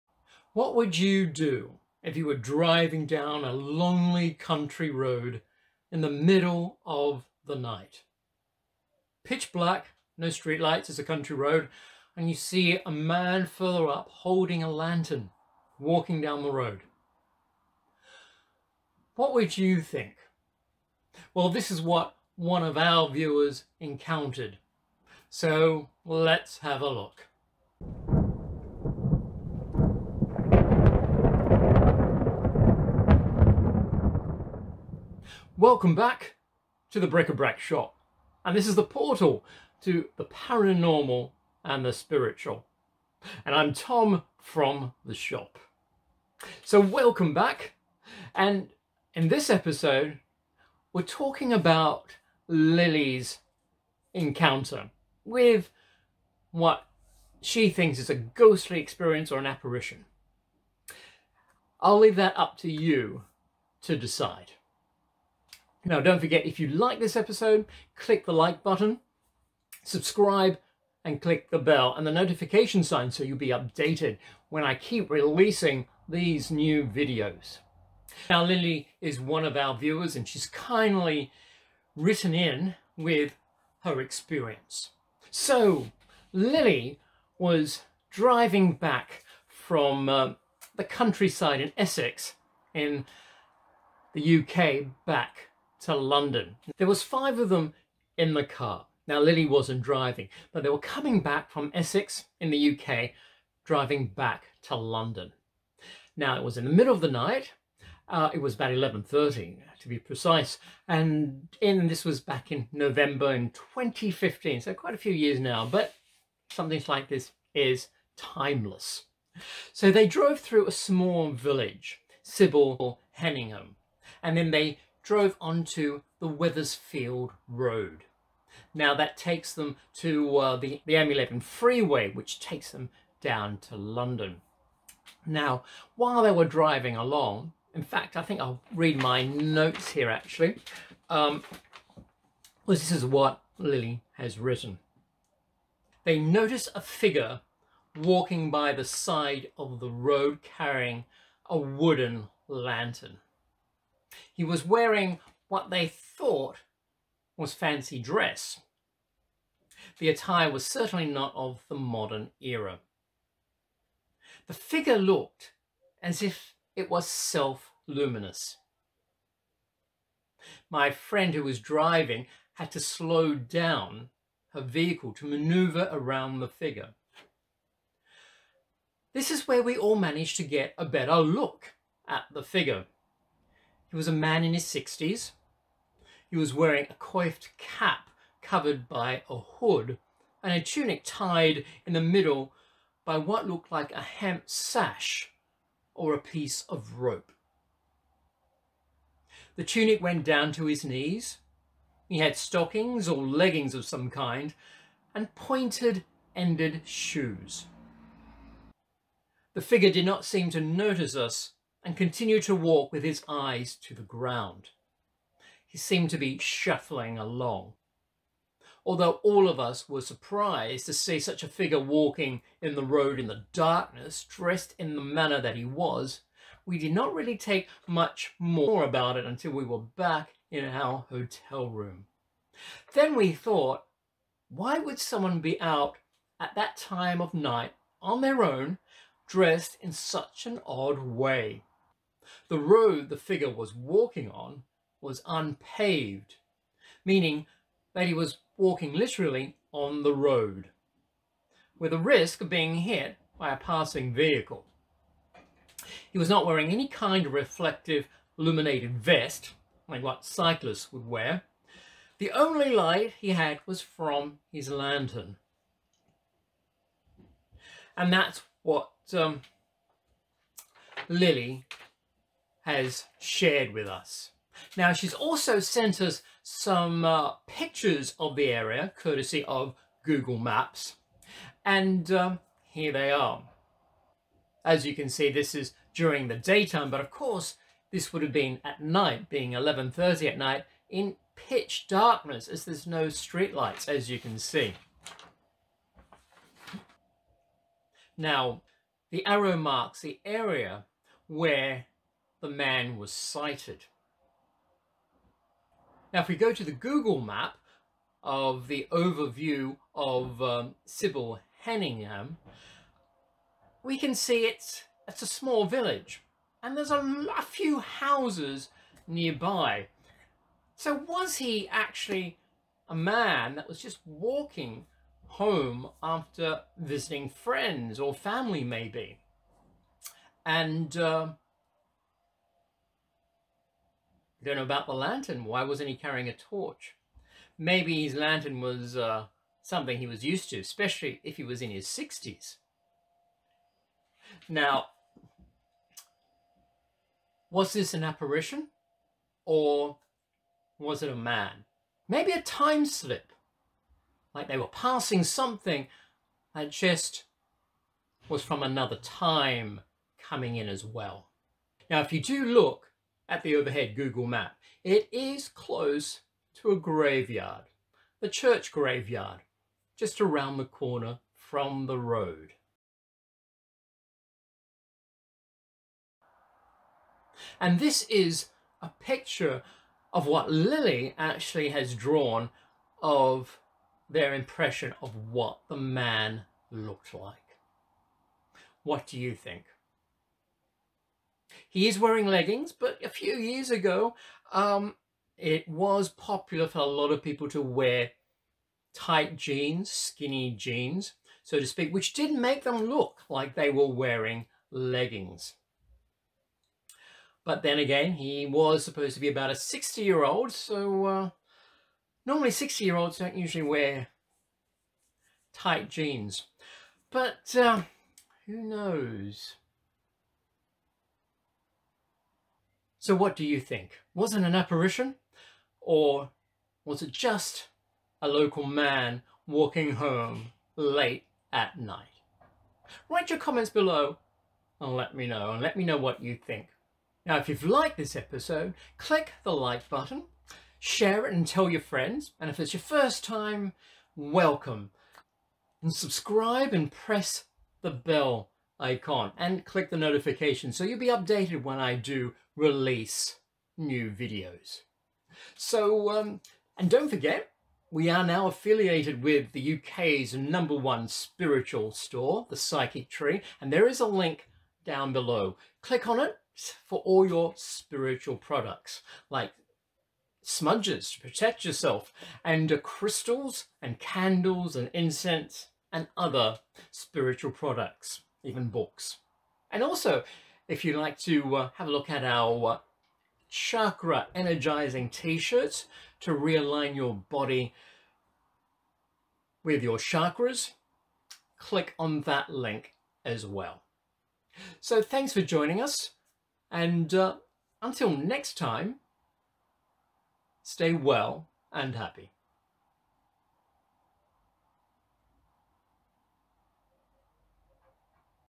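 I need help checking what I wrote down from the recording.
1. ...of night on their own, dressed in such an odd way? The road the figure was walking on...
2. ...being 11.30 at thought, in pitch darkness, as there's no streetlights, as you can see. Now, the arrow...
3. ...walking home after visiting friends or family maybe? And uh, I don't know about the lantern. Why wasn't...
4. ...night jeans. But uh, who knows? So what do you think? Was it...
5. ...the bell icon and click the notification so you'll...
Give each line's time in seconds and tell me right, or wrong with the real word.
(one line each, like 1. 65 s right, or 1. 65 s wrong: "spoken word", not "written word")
1. 237 s right
2. 289 s wrong: "night", not "thought"
3. 324 s right
4. 415 s wrong: "tight", not "night"
5. 447 s right.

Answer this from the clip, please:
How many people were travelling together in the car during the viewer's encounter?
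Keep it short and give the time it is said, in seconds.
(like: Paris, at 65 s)
5, at 97 s.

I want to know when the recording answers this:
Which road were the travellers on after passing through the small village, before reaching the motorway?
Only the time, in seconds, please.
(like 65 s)
126 s.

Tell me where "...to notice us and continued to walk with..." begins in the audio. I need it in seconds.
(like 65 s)
210 s.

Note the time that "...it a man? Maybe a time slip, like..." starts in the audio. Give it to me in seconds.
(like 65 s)
351 s.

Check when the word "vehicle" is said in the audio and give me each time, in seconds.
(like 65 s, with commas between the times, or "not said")
174 s, 254 s.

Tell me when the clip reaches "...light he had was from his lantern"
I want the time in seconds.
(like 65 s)
262 s.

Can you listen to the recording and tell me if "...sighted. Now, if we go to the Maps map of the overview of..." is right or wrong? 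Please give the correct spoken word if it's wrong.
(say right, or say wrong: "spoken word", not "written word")
wrong: "Google", not "Maps".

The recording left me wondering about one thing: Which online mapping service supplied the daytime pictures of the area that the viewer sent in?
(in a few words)
Google Maps.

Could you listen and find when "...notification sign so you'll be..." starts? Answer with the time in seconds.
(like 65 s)
72 s.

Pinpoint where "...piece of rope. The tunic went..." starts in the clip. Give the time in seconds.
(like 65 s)
196 s.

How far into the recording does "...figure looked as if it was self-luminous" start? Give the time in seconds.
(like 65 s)
164 s.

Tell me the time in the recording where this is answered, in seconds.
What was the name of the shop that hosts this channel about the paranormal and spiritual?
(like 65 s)
37 s.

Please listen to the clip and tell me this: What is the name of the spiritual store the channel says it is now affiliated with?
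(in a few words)
the Psychic Tree.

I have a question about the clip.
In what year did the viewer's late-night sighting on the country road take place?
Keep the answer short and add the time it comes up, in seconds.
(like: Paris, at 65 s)
2015, at 113 s.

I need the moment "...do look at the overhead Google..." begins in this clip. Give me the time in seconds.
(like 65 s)
362 s.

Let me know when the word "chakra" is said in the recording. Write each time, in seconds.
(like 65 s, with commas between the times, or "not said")
483 s, 489 s.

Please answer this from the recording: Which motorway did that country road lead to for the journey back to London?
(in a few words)
M11.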